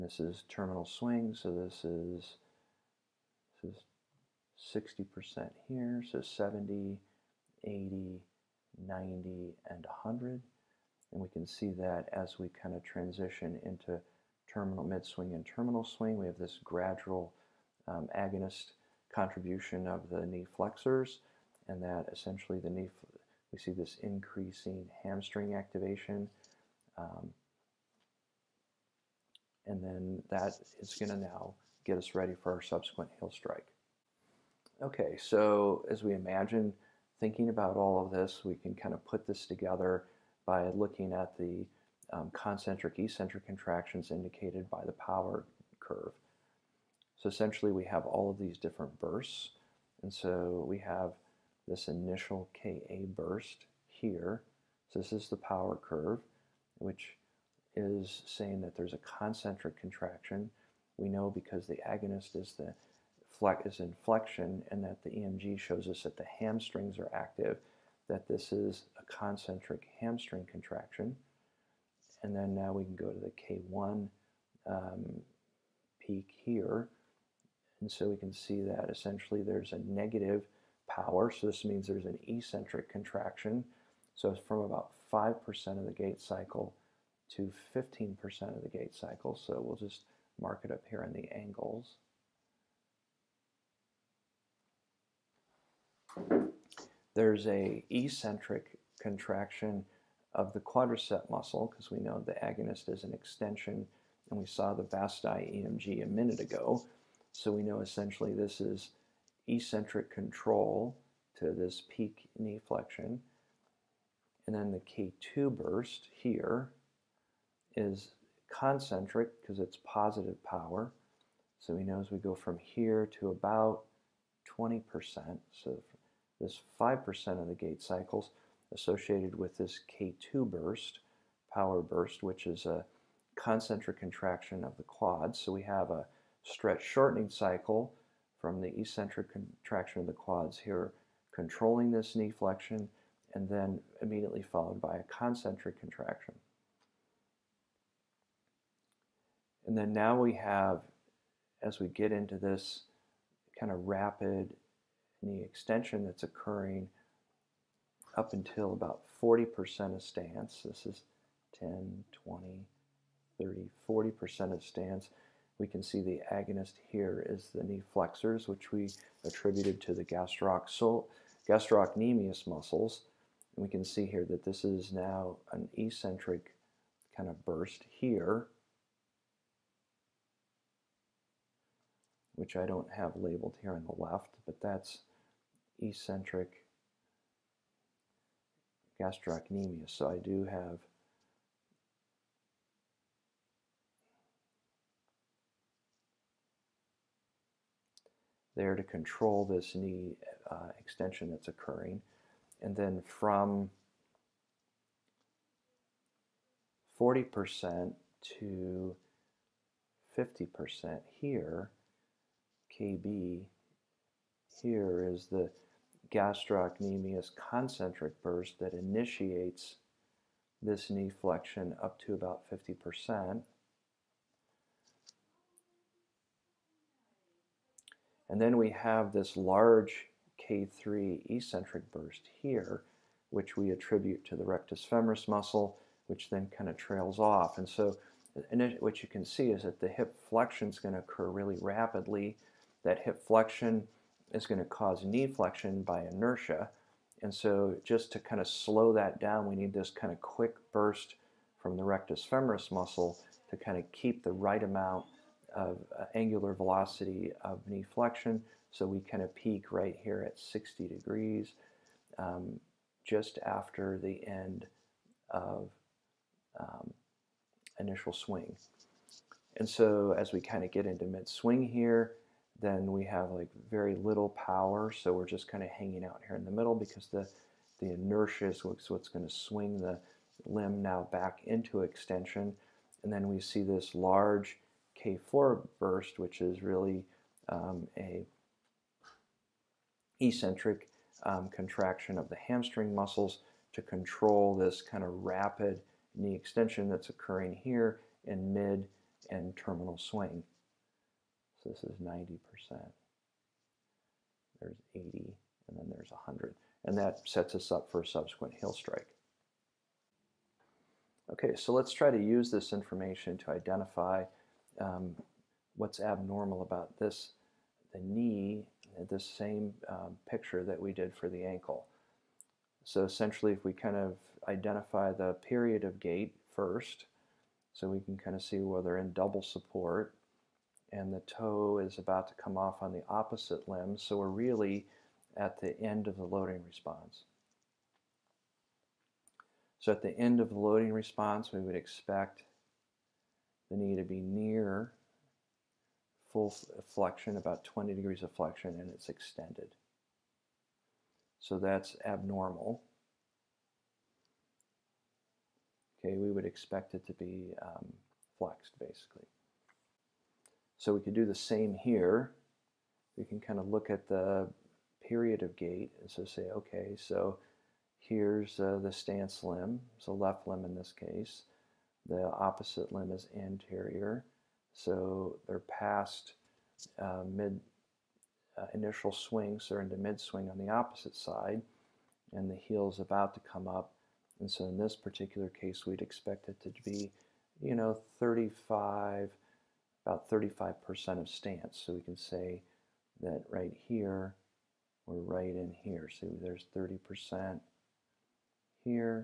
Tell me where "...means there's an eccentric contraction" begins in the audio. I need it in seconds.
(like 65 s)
81 s.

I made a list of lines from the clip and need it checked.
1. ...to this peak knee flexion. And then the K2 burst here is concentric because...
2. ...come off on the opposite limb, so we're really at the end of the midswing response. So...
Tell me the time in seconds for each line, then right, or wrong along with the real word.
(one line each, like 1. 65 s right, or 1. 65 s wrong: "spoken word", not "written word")
1. 111 s right
2. 332 s wrong: "loading", not "midswing".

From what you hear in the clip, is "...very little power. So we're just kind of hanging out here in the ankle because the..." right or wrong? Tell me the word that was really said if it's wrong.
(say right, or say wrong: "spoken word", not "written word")
wrong: "middle", not "ankle".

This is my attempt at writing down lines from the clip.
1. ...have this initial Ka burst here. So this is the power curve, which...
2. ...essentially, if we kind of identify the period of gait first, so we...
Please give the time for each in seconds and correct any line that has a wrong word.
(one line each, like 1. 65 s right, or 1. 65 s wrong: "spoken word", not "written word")
1. 50 s right
2. 323 s right.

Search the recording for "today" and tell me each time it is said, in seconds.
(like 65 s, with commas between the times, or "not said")
not said.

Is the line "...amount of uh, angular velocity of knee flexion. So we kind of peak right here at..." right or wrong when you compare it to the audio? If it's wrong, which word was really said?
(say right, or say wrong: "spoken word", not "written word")
right.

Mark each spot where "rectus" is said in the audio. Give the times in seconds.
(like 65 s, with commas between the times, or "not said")
234 s, 251 s.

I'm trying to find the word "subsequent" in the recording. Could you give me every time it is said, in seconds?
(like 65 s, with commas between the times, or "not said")
32 s, 308 s.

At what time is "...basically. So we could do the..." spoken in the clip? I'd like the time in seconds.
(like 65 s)
358 s.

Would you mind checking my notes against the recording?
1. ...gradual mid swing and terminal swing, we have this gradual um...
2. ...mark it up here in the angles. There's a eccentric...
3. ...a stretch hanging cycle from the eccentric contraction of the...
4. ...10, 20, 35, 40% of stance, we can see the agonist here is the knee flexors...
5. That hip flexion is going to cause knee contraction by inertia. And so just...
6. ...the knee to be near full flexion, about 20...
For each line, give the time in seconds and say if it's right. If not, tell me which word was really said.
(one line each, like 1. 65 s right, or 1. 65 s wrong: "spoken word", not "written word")
1. 14 s wrong: "terminal", not "gradual"
2. 90 s right
3. 135 s wrong: "shortening", not "hanging"
4. 161 s wrong: "30", not "35"
5. 242 s wrong: "flexion", not "contraction"
6. 343 s right.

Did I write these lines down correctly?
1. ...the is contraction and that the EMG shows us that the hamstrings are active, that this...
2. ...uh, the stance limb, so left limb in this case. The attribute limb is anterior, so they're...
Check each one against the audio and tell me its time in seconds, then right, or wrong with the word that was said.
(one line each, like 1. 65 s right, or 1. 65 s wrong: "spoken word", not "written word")
1. 62 s wrong: "inflection", not "contraction"
2. 368 s wrong: "opposite", not "attribute".